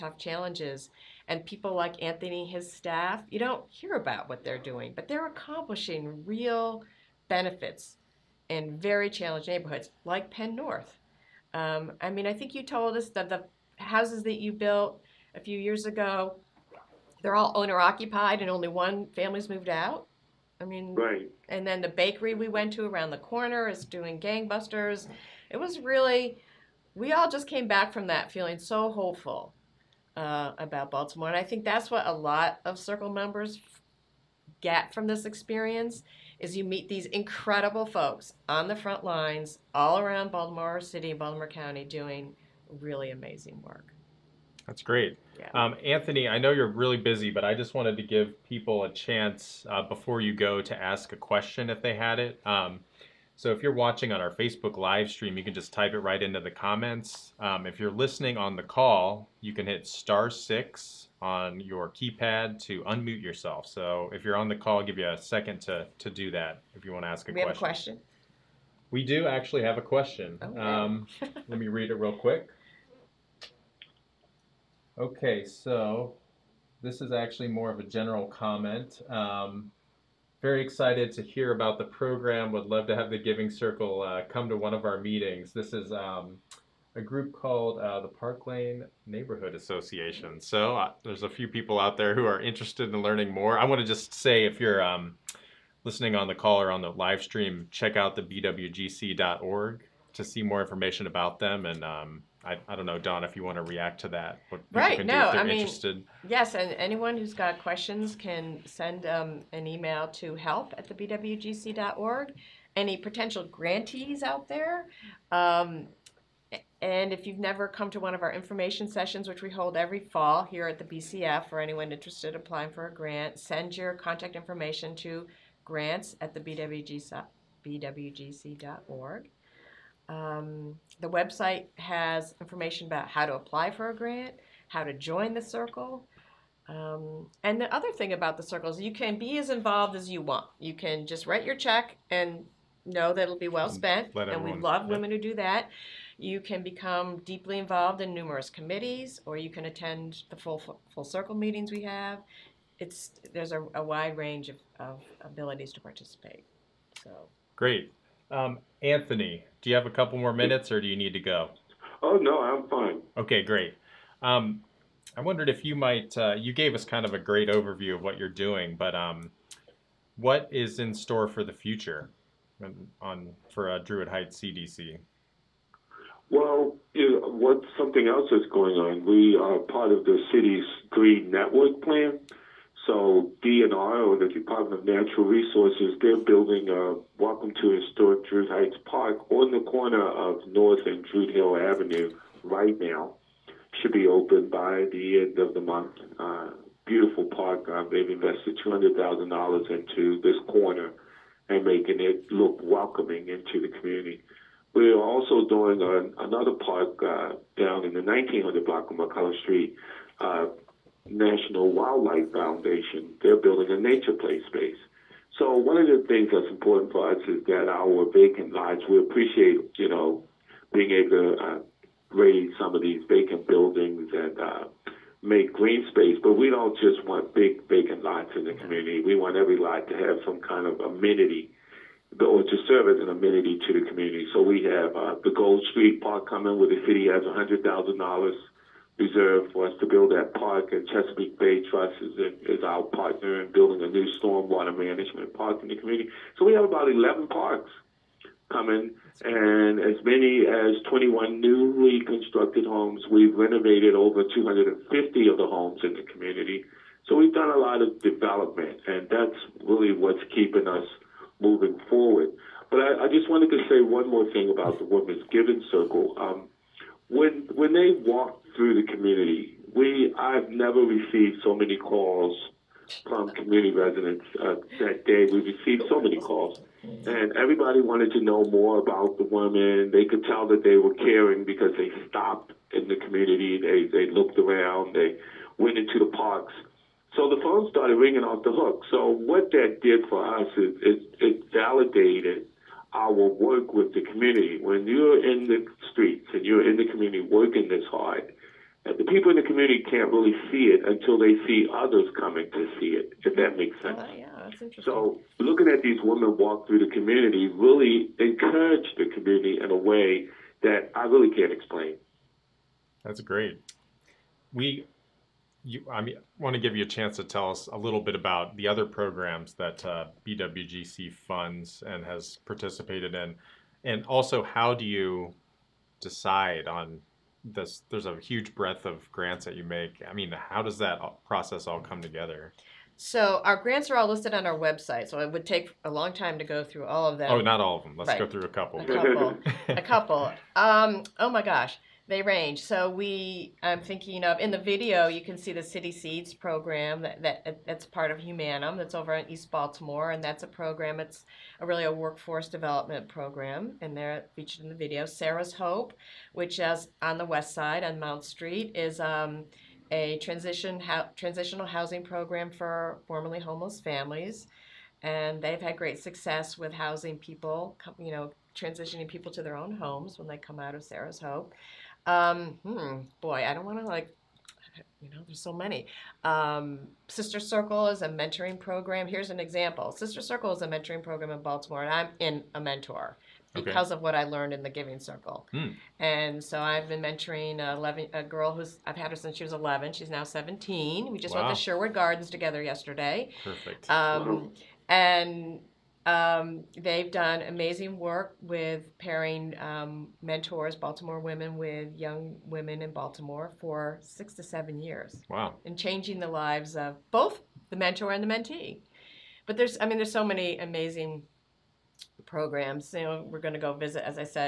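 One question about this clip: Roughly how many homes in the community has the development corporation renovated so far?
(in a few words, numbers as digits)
over 250.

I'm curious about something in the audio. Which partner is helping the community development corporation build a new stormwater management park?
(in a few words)
Chesapeake Bay Trust.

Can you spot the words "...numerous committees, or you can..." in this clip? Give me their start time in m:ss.
2:28.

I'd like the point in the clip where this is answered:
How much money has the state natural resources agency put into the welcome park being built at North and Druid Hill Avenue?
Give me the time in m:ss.
3:18.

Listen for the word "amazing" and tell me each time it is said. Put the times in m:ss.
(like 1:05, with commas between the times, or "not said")
0:43, 6:37, 6:50.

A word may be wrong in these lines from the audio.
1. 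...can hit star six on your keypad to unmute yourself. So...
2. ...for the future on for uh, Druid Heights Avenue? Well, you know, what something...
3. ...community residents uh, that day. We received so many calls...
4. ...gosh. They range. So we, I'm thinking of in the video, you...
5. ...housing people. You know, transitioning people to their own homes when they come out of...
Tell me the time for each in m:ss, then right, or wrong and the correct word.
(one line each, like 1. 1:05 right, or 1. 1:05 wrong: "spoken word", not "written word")
1. 0:59 right
2. 2:51 wrong: "CDC", not "Avenue"
3. 4:33 right
4. 5:41 right
5. 6:06 right.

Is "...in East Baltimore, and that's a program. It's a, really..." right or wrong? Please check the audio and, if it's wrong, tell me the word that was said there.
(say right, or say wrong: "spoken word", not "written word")
right.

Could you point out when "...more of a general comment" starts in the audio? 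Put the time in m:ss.
1:17.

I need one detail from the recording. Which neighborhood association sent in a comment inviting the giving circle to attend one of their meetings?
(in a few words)
Park Lane Neighborhood Association.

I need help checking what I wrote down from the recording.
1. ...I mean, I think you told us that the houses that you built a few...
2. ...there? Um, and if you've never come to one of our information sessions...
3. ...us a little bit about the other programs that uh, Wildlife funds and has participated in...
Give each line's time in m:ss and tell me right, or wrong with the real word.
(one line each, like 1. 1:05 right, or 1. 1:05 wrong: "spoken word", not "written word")
1. 0:11 right
2. 1:54 right
3. 5:17 wrong: "BWGC", not "Wildlife".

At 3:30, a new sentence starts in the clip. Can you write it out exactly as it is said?
Uh, National Wildlife Foundation, they're building a nature play space.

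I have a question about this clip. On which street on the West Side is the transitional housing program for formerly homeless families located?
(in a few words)
Mount Street.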